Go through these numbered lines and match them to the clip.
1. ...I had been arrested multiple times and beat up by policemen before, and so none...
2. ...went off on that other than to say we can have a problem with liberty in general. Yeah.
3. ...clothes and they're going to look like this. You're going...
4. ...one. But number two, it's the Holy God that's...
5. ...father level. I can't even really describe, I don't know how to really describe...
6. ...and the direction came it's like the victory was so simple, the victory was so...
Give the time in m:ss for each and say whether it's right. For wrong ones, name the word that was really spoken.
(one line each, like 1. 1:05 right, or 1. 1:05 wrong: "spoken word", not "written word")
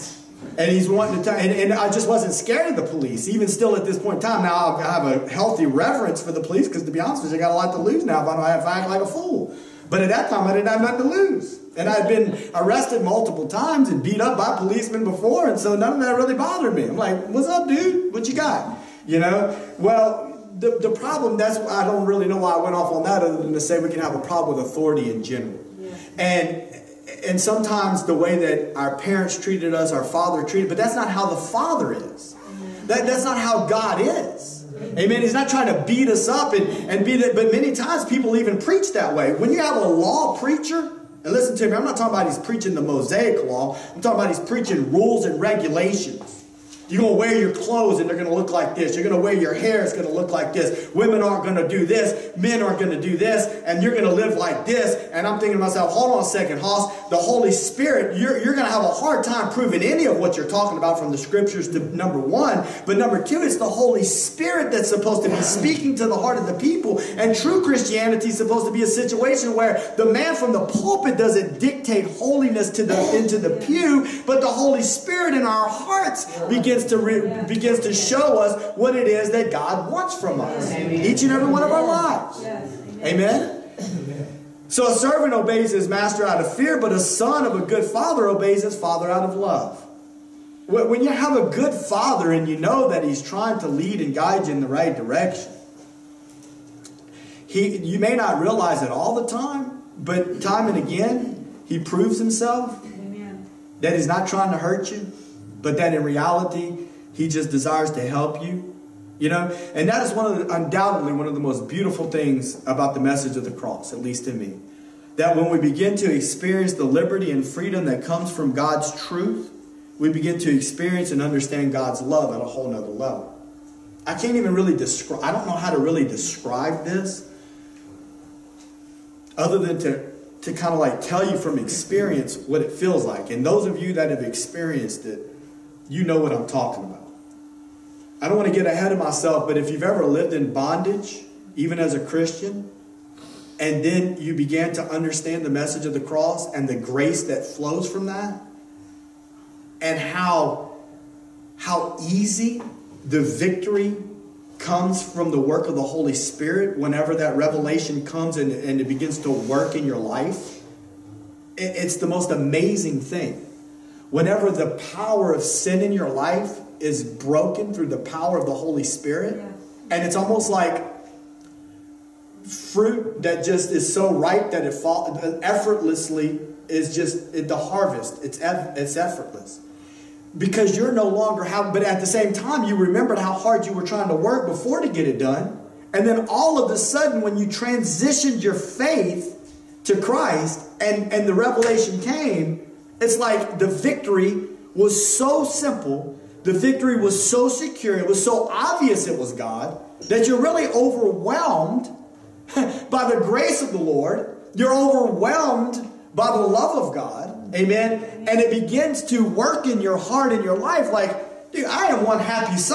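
1. 0:11 right
2. 0:22 wrong: "authority", not "liberty"
3. 0:47 right
4. 1:02 wrong: "Spirit", not "God"
5. 2:02 wrong: "nother", not "father"
6. 3:11 wrong: "revelation", not "direction".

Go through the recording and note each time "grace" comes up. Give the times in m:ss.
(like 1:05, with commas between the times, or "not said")
2:26, 3:23.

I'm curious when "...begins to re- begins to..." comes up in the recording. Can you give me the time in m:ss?
1:16.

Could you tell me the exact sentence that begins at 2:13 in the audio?
And those of you that have experienced it, you know what I'm talking about.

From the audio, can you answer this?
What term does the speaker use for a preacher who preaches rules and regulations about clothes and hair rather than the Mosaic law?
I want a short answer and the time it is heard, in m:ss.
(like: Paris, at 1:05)
Law preacher, at 0:39.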